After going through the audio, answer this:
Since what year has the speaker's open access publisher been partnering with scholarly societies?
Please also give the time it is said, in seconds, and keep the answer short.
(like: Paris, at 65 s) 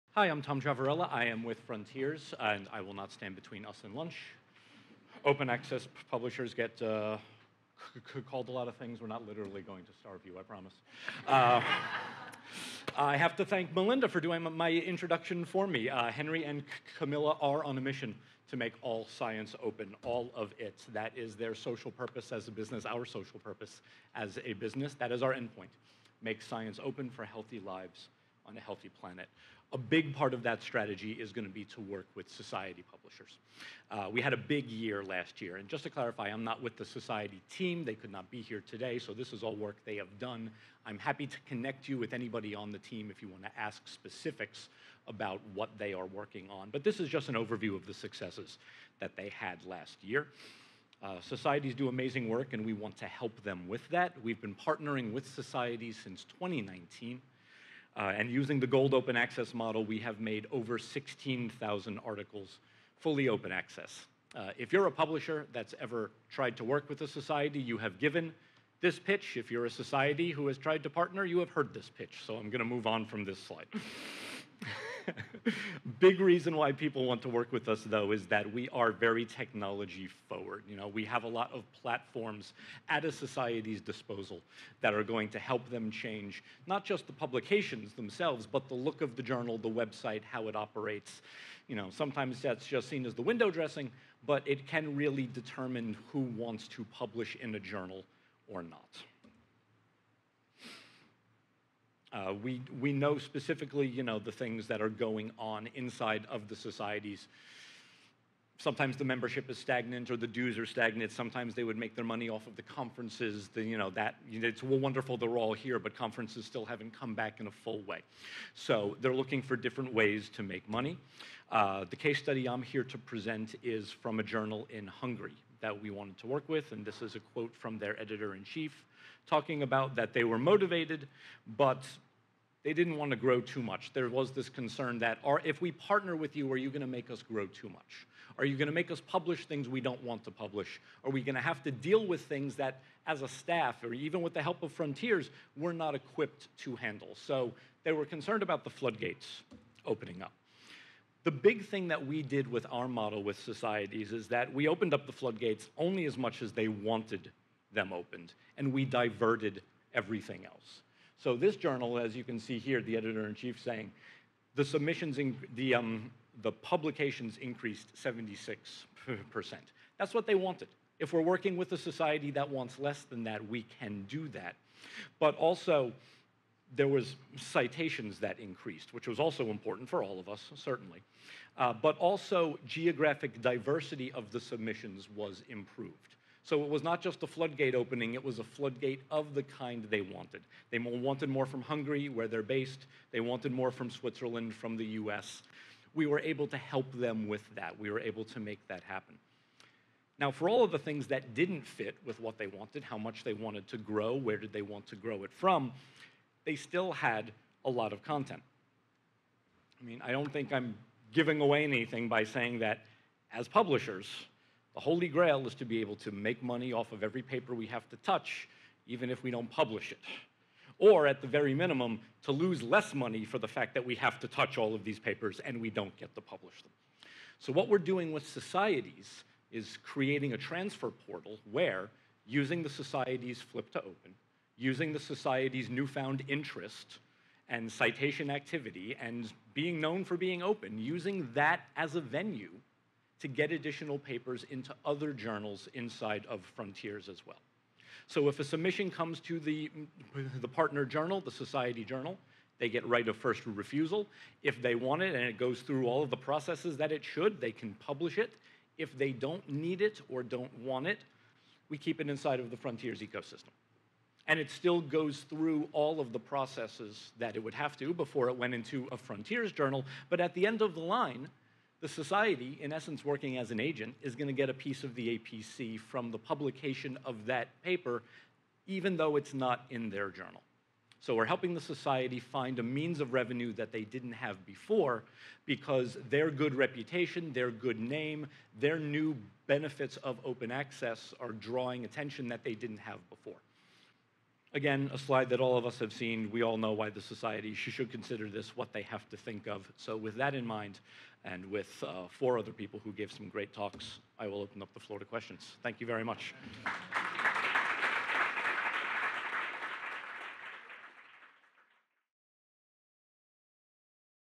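2019, at 56 s.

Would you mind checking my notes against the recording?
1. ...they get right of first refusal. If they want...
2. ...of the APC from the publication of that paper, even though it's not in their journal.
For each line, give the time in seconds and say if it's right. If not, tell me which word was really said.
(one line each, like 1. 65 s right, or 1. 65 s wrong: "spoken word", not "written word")
1. 252 s right
2. 274 s right.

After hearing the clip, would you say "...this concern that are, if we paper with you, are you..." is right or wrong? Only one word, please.
wrong.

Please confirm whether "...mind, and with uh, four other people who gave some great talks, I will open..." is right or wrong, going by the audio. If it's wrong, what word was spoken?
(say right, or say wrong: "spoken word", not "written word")
right.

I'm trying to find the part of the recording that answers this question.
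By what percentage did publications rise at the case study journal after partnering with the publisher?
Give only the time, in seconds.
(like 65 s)
167 s.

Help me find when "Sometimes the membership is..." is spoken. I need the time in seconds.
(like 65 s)
108 s.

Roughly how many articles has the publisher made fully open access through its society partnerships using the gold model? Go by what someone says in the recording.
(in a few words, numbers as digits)
16,000.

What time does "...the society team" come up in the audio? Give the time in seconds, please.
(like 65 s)
36 s.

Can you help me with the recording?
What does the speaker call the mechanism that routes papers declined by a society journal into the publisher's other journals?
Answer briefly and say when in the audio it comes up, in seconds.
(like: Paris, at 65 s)
transfer portal, at 230 s.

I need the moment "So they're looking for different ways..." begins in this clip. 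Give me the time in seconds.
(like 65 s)
118 s.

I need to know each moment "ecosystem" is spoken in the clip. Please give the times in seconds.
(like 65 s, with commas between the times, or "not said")
263 s.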